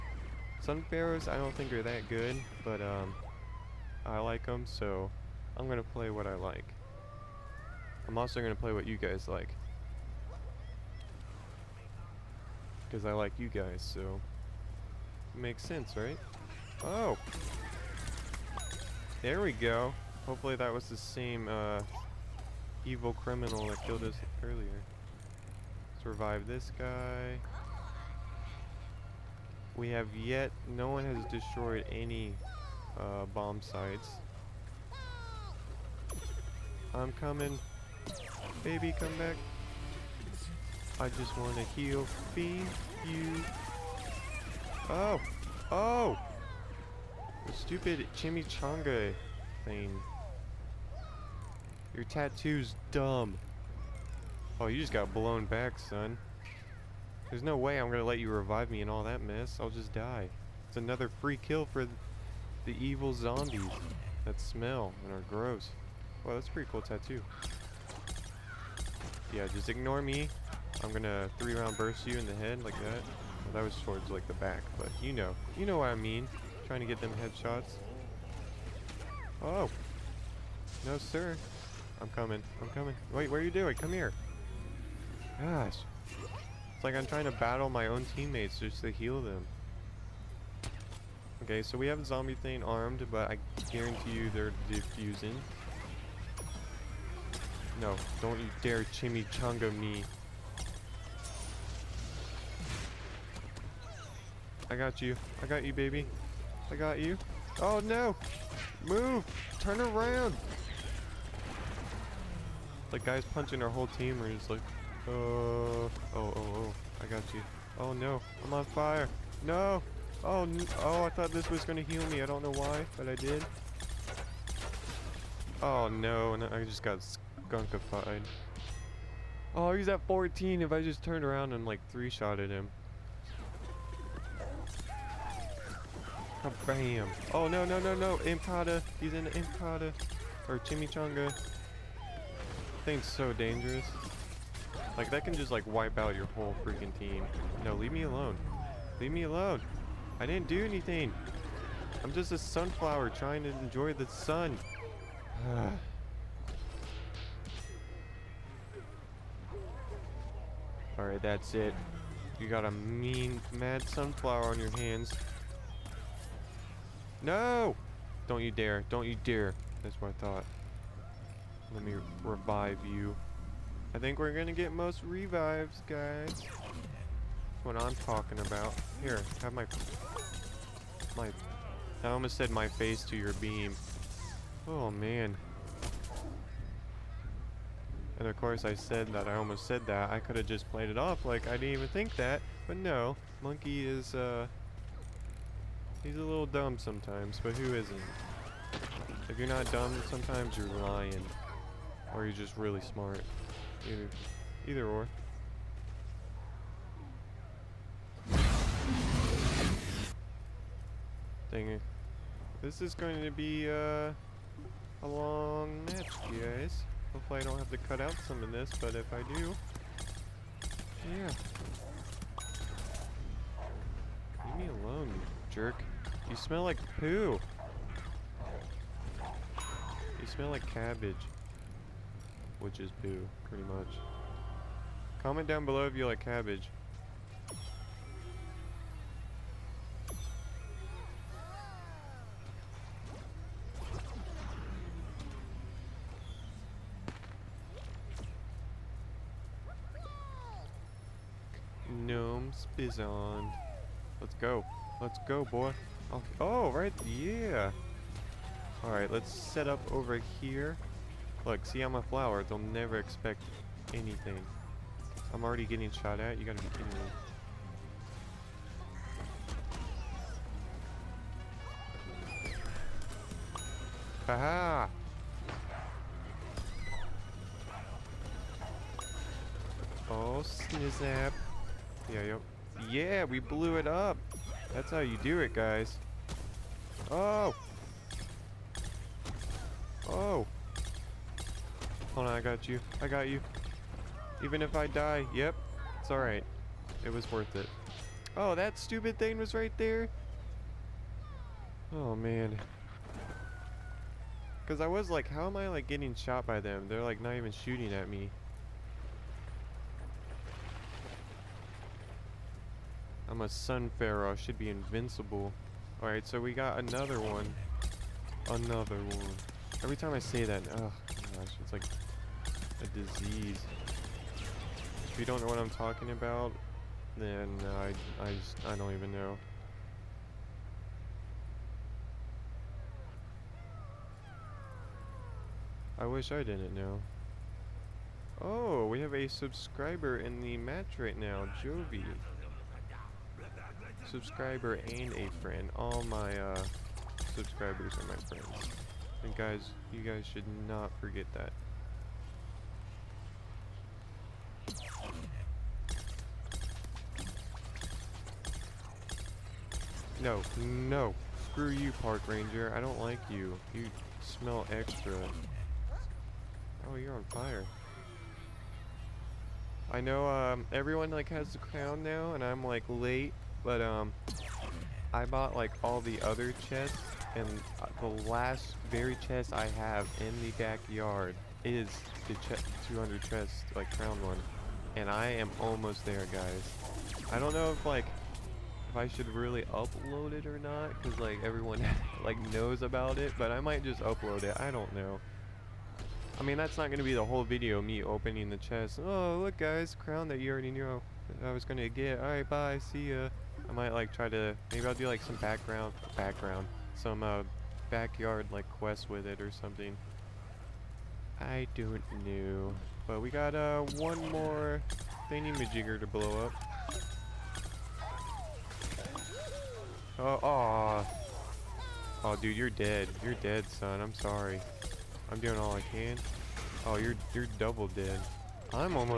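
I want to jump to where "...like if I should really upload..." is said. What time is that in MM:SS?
06:27.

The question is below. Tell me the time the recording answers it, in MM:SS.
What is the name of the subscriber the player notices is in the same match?
05:41.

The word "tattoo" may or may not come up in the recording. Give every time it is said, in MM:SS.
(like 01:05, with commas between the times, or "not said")
00:52, 01:06.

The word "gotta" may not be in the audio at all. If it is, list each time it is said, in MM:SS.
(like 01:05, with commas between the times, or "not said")
04:26.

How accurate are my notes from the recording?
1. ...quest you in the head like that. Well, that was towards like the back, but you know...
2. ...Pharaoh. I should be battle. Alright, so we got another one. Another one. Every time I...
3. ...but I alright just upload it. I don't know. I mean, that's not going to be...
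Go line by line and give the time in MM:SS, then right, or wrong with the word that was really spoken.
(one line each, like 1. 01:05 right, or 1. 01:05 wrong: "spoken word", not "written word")
1. 01:11 wrong: "burst", not "quest"
2. 05:13 wrong: "invincible", not "battle"
3. 06:33 wrong: "might", not "alright".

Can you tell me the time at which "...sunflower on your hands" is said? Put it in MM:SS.
02:43.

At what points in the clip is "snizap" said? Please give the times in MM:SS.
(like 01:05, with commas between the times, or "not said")
04:40.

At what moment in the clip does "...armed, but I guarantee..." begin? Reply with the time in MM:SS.
01:32.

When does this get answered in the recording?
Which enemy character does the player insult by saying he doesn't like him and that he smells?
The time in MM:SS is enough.
06:02.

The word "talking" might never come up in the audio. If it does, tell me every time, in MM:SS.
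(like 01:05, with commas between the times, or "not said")
02:58, 05:25.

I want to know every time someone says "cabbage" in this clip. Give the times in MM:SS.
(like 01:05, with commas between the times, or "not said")
03:50, 03:56.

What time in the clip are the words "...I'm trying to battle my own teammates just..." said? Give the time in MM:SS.
01:26.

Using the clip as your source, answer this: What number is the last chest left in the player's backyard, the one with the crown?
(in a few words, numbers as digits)
200.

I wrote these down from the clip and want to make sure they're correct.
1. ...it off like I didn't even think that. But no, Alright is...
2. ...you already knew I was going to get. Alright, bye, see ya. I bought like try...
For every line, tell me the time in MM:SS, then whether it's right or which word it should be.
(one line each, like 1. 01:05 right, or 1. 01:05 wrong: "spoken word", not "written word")
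1. 03:10 wrong: "Monkey", not "Alright"
2. 06:40 wrong: "might", not "bought".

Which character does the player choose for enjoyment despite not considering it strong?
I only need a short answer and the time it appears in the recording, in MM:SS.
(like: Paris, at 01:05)
Sun Pharaohs, at 00:00.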